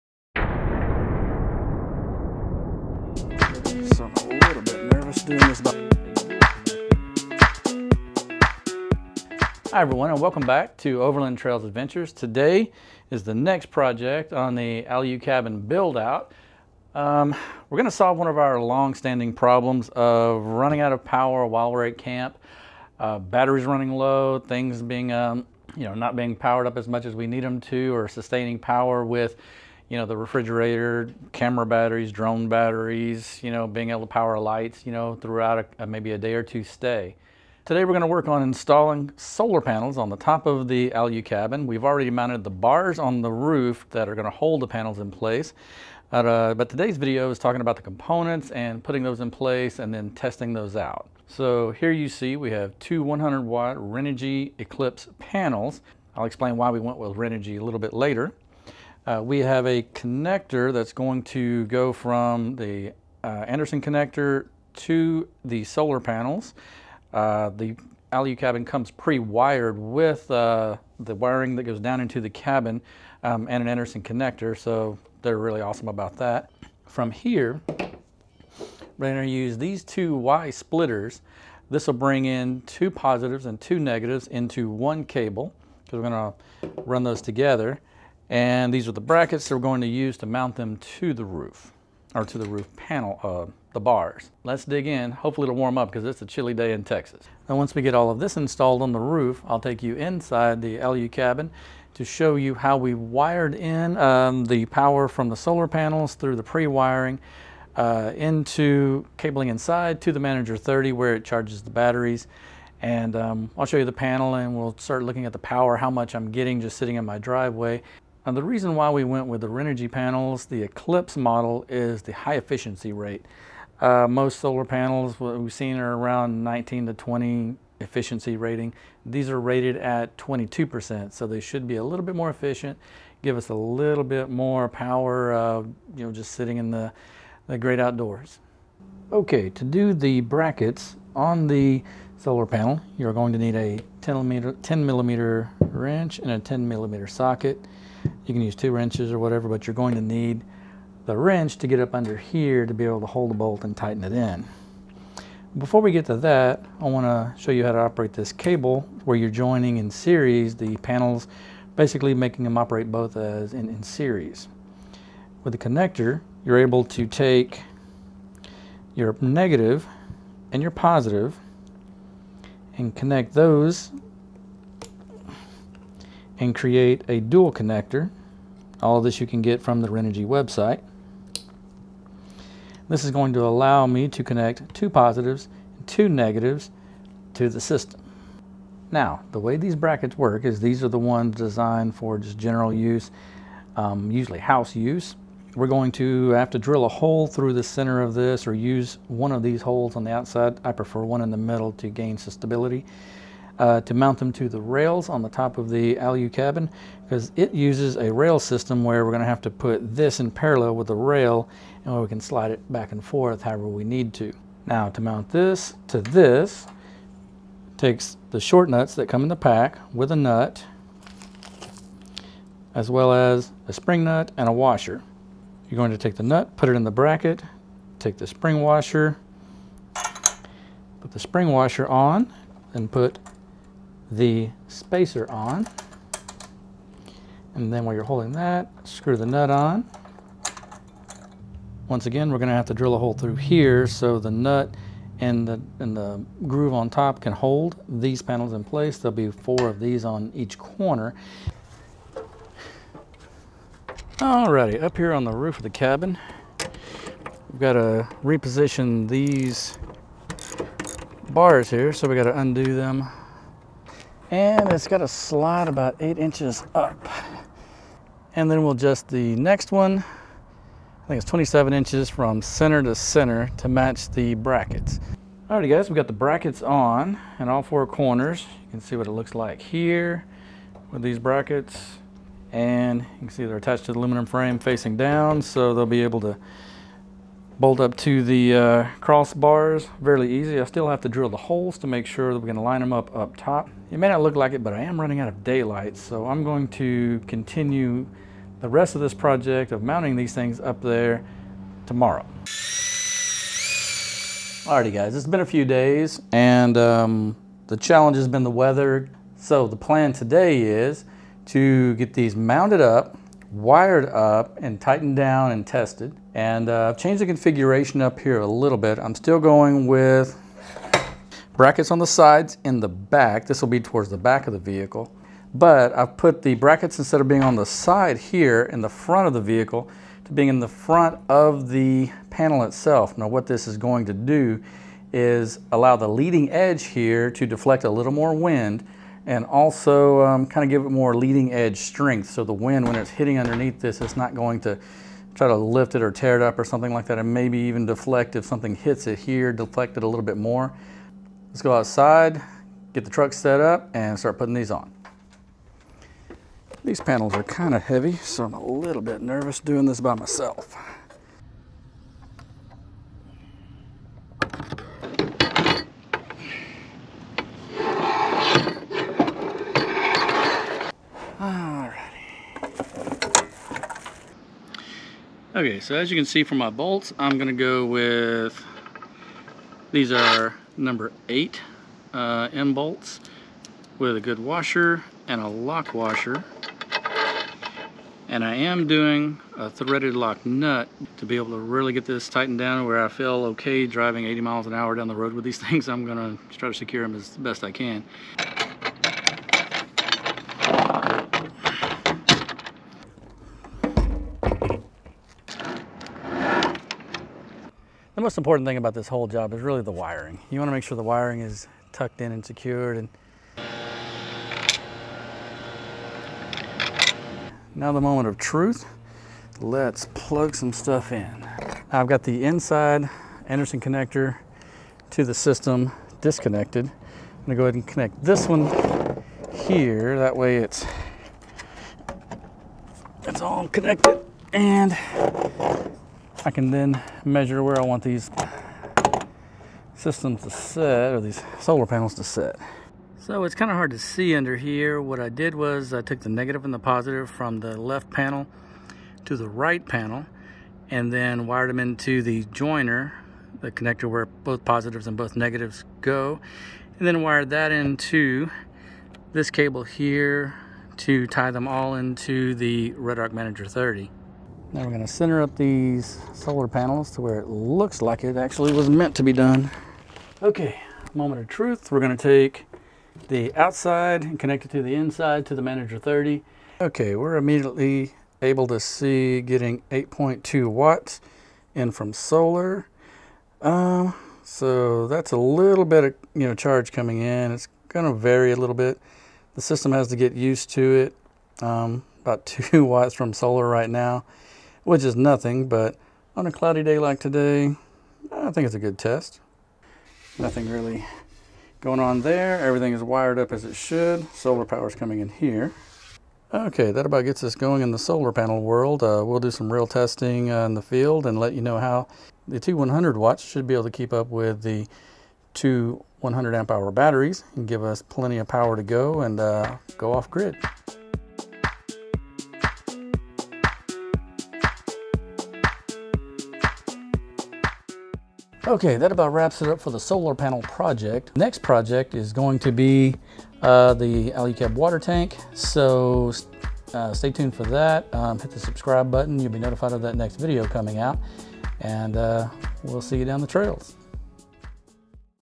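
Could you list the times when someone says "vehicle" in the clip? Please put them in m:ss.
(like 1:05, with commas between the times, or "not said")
5:24, 5:29.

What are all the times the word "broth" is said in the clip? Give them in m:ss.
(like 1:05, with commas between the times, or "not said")
not said.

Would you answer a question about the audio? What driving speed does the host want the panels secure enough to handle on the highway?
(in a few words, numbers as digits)
80 mph.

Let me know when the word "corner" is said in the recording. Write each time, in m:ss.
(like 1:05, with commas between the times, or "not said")
4:10, 4:37.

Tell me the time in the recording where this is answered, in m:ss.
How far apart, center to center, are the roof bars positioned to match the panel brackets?
4:31.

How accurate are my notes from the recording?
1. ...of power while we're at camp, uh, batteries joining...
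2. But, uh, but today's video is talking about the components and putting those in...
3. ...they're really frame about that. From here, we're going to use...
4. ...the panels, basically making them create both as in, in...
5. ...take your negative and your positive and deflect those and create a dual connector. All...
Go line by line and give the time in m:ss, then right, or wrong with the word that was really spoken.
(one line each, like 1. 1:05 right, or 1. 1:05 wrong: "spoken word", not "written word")
1. 0:20 wrong: "running", not "joining"
2. 0:46 right
3. 1:15 wrong: "awesome", not "frame"
4. 2:40 wrong: "operate", not "create"
5. 2:47 wrong: "connect", not "deflect".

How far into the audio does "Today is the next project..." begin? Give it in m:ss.
0:12.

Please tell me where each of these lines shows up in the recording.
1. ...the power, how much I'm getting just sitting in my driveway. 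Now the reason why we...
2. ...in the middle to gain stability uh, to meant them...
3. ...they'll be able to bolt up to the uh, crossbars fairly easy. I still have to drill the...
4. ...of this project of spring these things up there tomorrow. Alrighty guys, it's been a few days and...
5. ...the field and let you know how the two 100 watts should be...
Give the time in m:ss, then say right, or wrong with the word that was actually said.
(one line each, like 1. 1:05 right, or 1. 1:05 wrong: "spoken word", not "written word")
1. 1:55 right
2. 3:21 wrong: "mount", not "meant"
3. 4:45 right
4. 4:58 wrong: "mounting", not "spring"
5. 8:30 right.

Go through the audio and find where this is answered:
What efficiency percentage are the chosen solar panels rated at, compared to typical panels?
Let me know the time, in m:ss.
2:10.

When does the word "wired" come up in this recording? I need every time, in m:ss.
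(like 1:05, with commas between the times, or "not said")
1:08, 1:42, 5:13, 7:31, 7:37, 8:23.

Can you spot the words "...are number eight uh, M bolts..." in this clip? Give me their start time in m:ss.
6:20.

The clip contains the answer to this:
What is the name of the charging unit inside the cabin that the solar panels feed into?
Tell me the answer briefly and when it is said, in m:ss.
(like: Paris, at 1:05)
REDARC Manager 30, at 7:42.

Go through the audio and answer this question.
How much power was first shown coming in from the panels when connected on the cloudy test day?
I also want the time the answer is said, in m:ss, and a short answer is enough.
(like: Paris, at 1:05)
8.2 watts, at 7:59.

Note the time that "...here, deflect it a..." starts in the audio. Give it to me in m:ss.
5:49.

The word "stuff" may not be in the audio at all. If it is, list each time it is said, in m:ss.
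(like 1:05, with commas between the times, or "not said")
7:00.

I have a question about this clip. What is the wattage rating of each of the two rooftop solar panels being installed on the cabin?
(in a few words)
100 watts.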